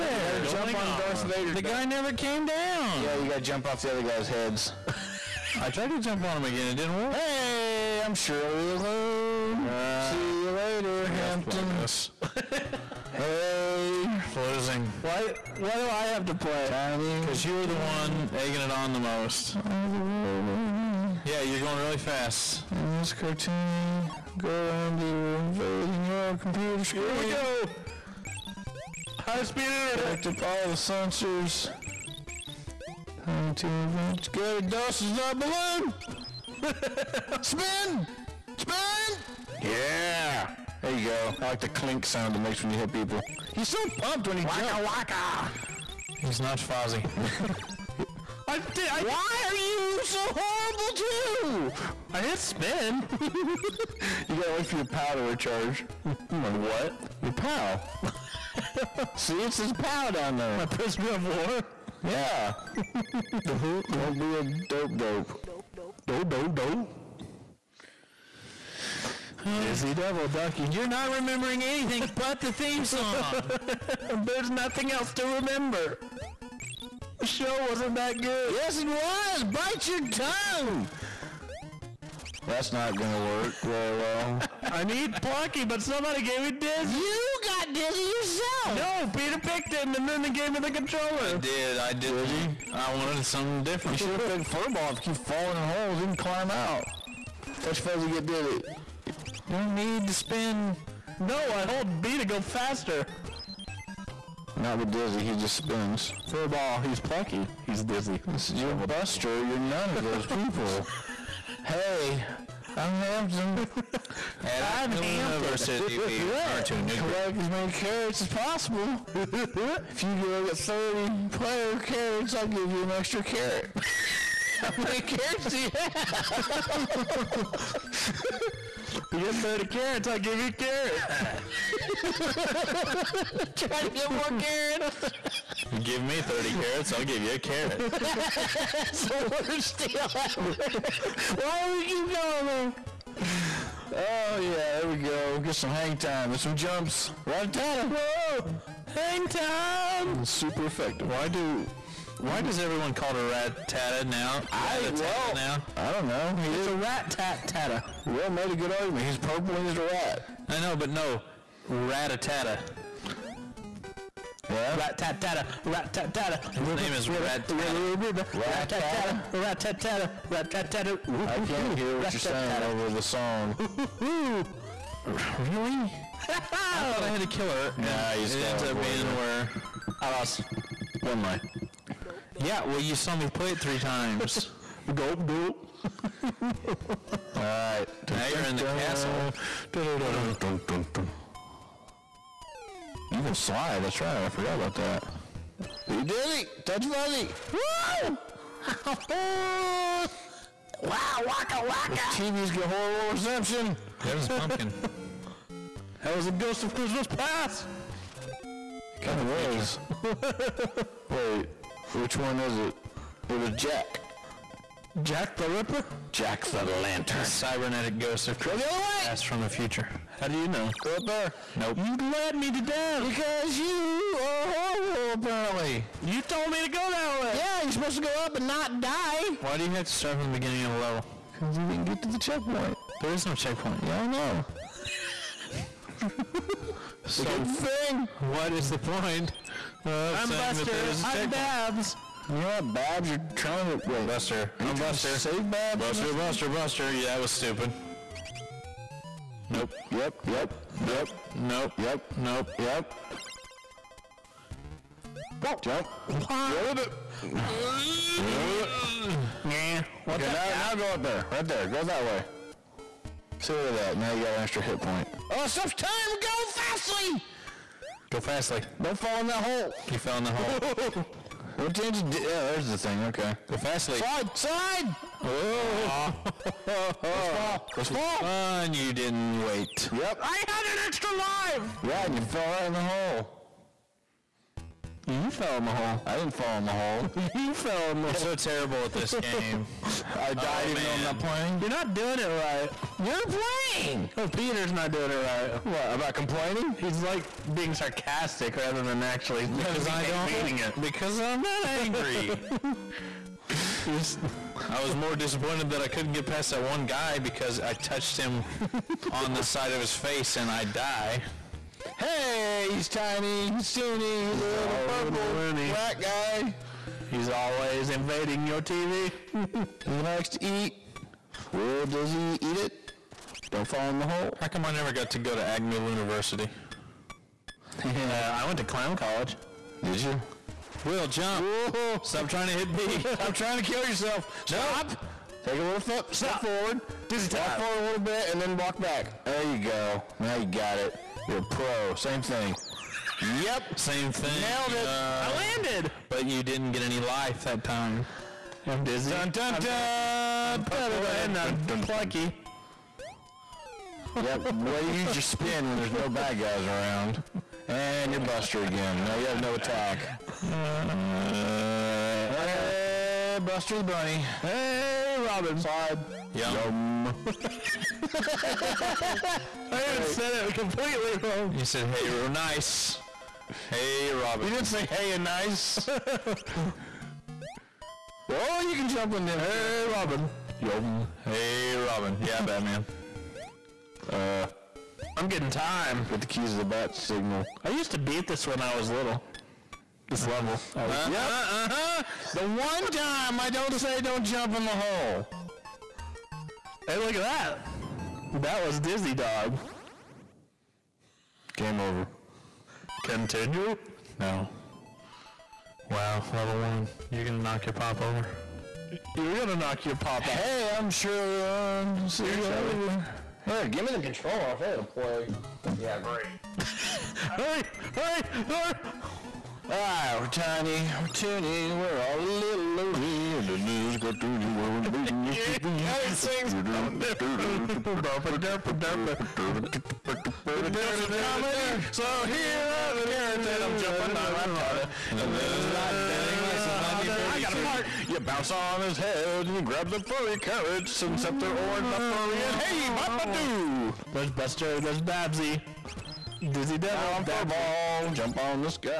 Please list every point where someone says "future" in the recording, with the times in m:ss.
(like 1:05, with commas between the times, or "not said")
3:39.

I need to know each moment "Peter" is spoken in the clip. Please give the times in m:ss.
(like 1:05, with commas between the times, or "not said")
1:29, 4:54.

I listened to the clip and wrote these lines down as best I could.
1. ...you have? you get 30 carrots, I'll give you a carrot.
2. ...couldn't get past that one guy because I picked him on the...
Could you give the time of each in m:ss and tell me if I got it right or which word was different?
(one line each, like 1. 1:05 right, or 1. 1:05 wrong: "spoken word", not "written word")
1. 2:05 right
2. 5:05 wrong: "touched", not "picked".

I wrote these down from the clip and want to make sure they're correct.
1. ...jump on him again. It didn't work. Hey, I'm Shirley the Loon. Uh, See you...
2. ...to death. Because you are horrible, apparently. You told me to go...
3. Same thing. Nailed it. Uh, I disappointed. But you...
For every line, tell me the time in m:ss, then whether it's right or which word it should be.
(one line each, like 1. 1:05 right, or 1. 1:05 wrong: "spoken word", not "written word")
1. 0:05 right
2. 3:42 right
3. 5:43 wrong: "landed", not "disappointed".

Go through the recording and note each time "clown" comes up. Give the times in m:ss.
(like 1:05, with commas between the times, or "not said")
5:28.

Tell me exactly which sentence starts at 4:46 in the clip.
I didn't fall in the hole.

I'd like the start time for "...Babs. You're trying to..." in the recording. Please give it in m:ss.
4:02.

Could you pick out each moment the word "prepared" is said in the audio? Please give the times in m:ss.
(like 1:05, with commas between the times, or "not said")
not said.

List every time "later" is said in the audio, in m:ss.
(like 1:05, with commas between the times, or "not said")
0:10, 6:52.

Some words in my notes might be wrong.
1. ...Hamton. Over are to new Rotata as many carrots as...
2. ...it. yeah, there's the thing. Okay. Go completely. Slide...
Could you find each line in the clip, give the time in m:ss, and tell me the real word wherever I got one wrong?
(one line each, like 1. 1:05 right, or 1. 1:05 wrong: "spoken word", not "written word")
1. 1:54 wrong: "Collect", not "Rotata"
2. 4:31 wrong: "fastly", not "completely".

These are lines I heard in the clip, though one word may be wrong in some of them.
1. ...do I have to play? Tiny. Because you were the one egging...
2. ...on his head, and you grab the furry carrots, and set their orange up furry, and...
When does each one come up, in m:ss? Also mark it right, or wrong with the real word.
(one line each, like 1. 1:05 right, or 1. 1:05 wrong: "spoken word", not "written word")
1. 0:15 right
2. 7:18 right.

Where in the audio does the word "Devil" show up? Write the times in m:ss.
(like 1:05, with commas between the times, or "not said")
1:09, 7:26.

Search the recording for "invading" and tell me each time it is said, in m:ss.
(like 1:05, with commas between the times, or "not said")
0:25, 5:17.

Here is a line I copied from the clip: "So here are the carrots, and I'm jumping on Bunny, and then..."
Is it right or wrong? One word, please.
wrong.